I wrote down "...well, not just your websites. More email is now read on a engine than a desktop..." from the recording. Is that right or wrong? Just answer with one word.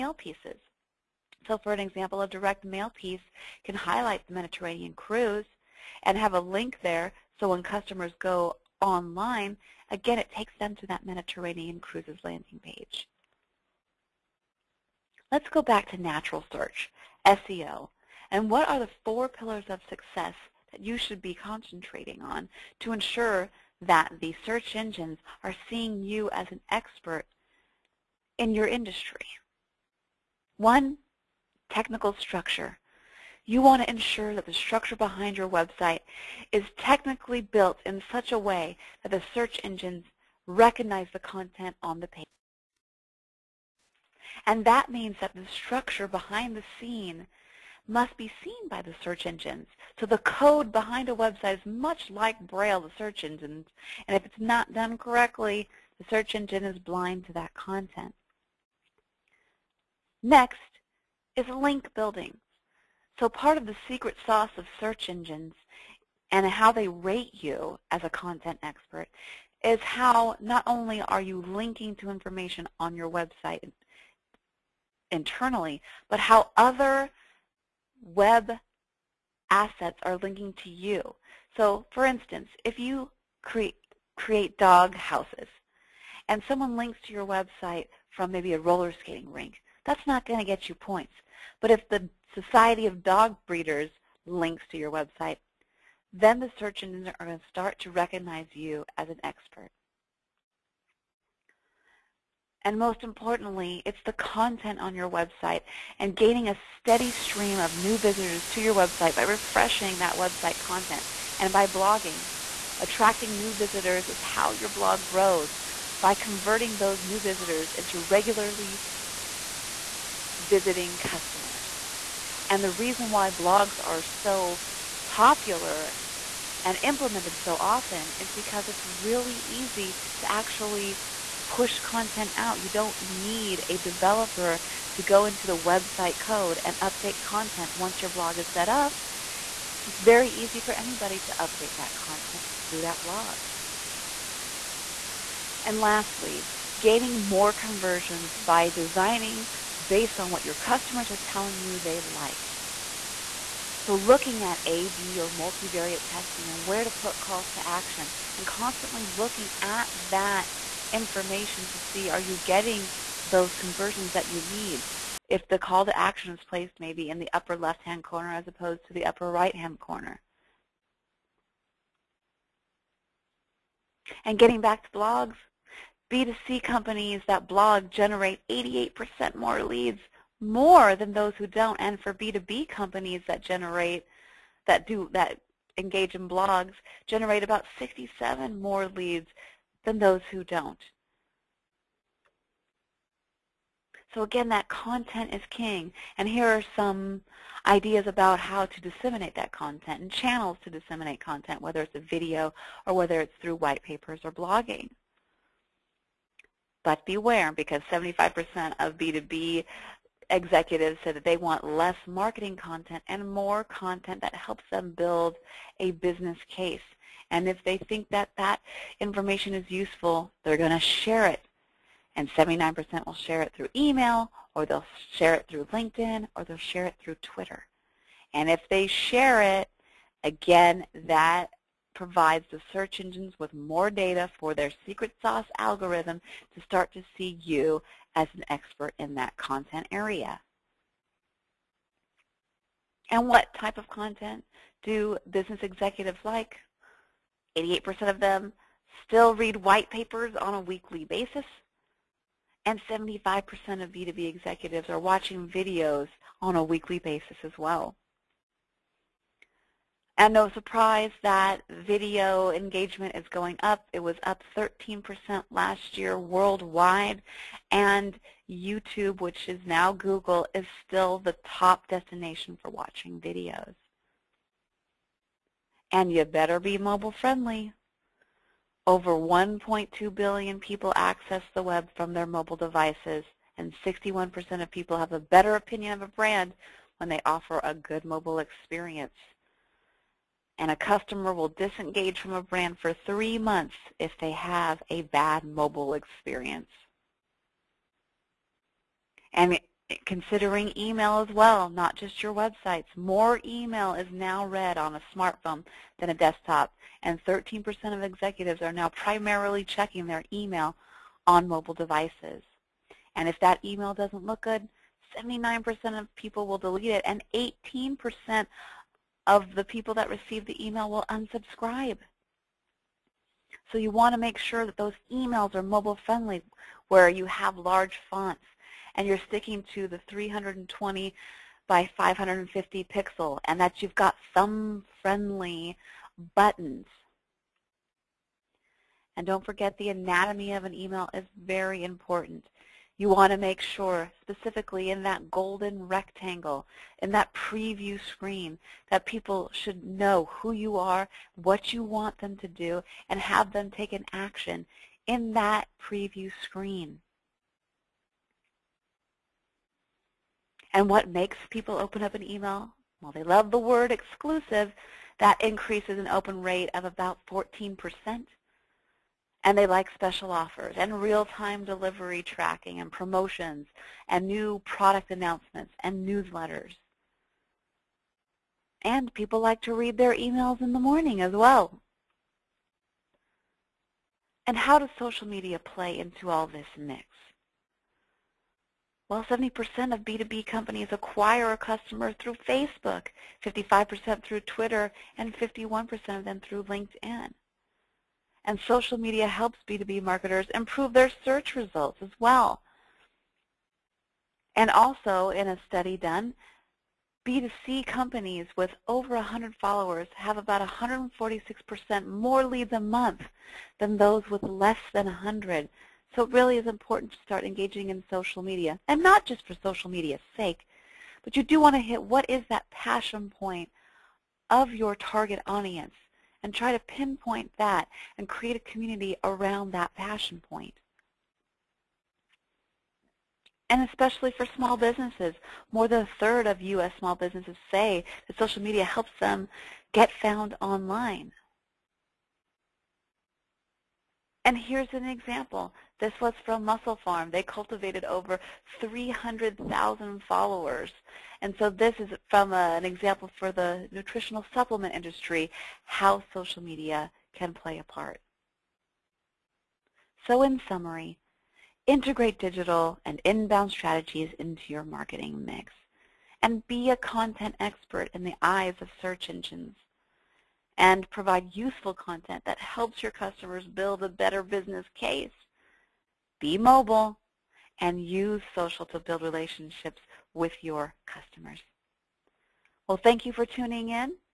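wrong.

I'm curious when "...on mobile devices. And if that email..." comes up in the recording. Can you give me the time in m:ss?
5:11.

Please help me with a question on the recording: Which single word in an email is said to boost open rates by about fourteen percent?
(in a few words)
exclusive.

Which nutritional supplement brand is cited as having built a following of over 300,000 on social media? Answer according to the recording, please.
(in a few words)
MusclePharm.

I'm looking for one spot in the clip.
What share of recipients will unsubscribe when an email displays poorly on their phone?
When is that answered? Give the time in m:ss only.
5:17.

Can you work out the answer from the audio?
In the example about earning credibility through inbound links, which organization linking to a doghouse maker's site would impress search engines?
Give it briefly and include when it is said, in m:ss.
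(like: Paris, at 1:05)
Society of Dog Breeders, at 1:32.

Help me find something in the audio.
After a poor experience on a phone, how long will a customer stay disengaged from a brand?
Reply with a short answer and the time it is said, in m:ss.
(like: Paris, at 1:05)
three months, at 4:53.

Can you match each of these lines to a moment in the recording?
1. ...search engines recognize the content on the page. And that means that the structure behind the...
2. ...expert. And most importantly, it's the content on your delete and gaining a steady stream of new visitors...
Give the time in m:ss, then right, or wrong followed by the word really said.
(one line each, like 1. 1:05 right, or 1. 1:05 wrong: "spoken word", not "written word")
1. 0:39 right
2. 1:39 wrong: "website", not "delete".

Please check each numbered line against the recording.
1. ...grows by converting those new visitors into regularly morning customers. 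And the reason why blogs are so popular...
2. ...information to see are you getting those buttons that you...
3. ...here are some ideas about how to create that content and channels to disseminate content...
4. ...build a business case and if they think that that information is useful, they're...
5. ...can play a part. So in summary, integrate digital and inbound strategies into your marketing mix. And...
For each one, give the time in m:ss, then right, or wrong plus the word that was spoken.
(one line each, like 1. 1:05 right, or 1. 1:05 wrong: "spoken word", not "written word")
1. 1:55 wrong: "visiting", not "morning"
2. 2:40 wrong: "conversions", not "buttons"
3. 3:16 wrong: "disseminate", not "create"
4. 3:34 right
5. 7:37 right.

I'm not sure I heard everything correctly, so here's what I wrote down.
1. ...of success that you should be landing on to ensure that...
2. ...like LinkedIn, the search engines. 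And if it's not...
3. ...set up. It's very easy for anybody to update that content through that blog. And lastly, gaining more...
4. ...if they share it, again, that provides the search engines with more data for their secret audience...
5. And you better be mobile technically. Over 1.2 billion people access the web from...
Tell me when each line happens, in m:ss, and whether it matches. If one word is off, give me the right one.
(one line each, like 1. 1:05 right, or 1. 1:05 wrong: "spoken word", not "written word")
1. 0:19 wrong: "concentrating", not "landing"
2. 0:52 wrong: "Braille", not "LinkedIn"
3. 2:18 right
4. 3:48 wrong: "sauce", not "audience"
5. 4:35 wrong: "friendly", not "technically".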